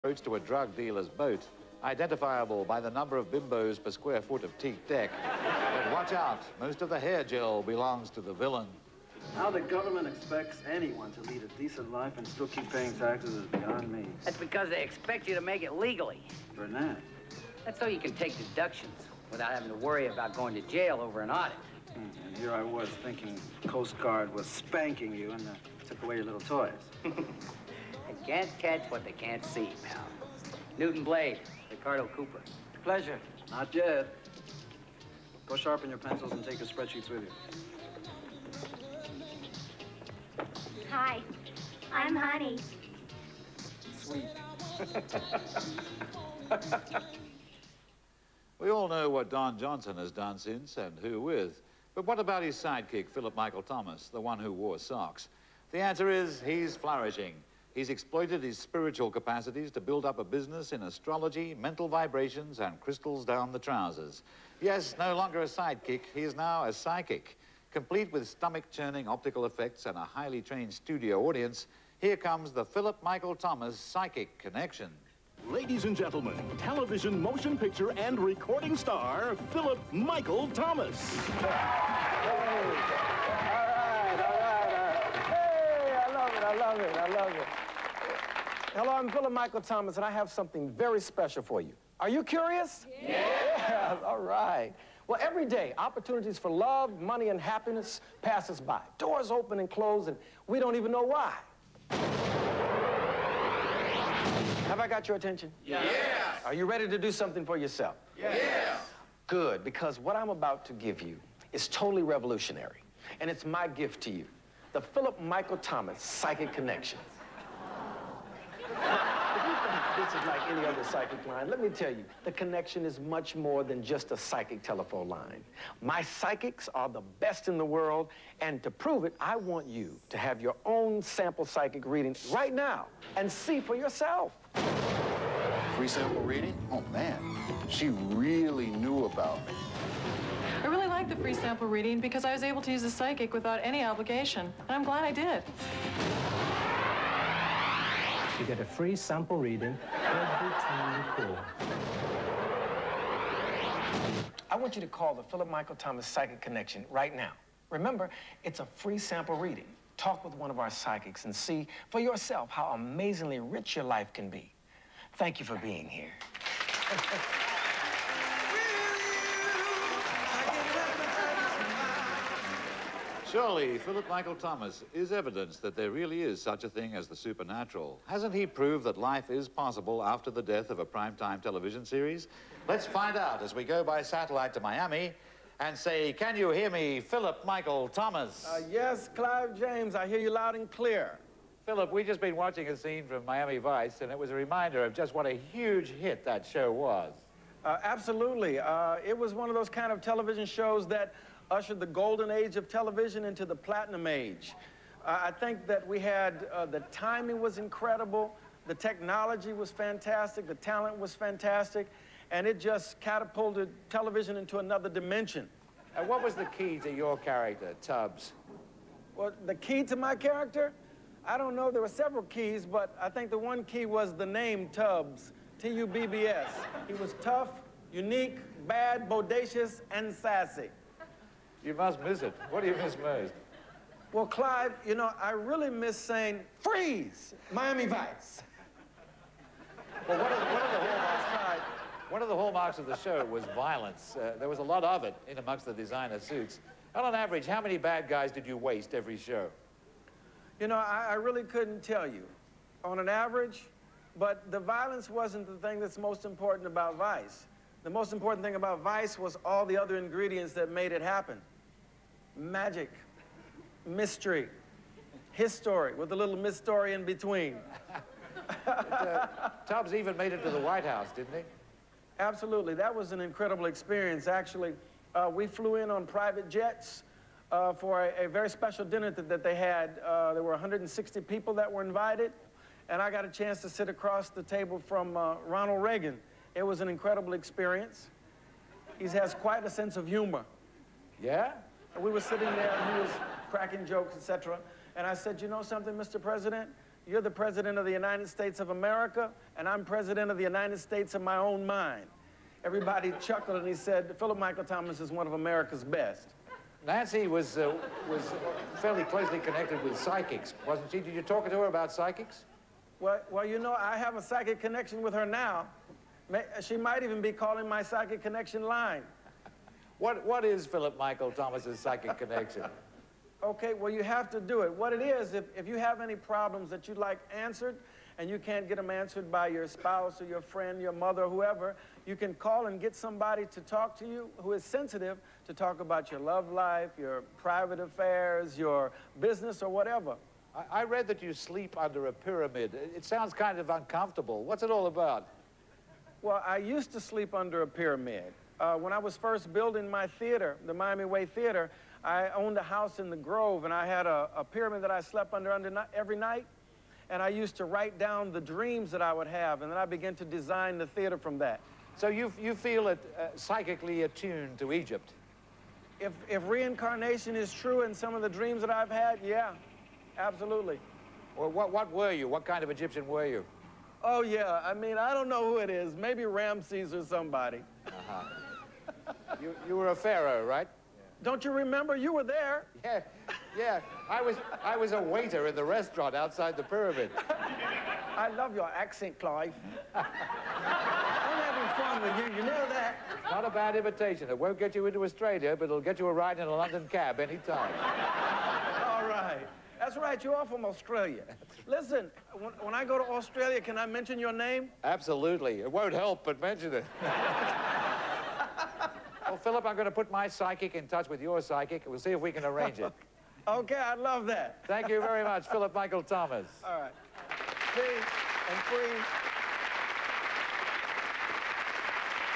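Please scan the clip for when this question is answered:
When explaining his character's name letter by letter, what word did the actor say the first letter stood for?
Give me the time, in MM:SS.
03:47.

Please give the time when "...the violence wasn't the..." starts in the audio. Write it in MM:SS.
04:14.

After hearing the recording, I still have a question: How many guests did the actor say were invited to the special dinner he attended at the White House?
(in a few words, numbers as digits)
160.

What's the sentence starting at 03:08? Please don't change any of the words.
Uh, yes, Clive James, I hear you loud and clear.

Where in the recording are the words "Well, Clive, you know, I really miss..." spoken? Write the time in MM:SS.
03:54.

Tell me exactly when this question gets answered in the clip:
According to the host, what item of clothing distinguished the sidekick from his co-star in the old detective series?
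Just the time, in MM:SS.
00:54.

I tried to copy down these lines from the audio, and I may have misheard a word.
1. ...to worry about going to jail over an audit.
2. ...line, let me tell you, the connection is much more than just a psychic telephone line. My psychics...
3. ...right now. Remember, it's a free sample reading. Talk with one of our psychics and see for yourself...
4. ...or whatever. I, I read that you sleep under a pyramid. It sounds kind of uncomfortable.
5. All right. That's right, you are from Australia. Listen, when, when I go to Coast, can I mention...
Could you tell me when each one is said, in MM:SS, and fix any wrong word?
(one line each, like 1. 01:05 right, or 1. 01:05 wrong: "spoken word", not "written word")
1. 00:19 right
2. 02:01 right
3. 02:36 right
4. 05:39 right
5. 06:38 wrong: "Australia", not "Coast".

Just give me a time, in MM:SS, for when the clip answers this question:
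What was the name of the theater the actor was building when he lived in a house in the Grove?
05:50.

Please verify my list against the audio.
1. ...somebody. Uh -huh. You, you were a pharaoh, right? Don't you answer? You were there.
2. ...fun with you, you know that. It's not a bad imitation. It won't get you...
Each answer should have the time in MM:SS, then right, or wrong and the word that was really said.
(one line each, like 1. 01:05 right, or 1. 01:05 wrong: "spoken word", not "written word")
1. 06:17 wrong: "remember", not "answer"
2. 06:31 right.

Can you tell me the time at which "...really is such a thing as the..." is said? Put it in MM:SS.
02:55.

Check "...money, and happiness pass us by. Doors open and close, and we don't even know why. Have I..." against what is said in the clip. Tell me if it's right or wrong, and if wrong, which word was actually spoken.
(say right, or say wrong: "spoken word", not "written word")
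right.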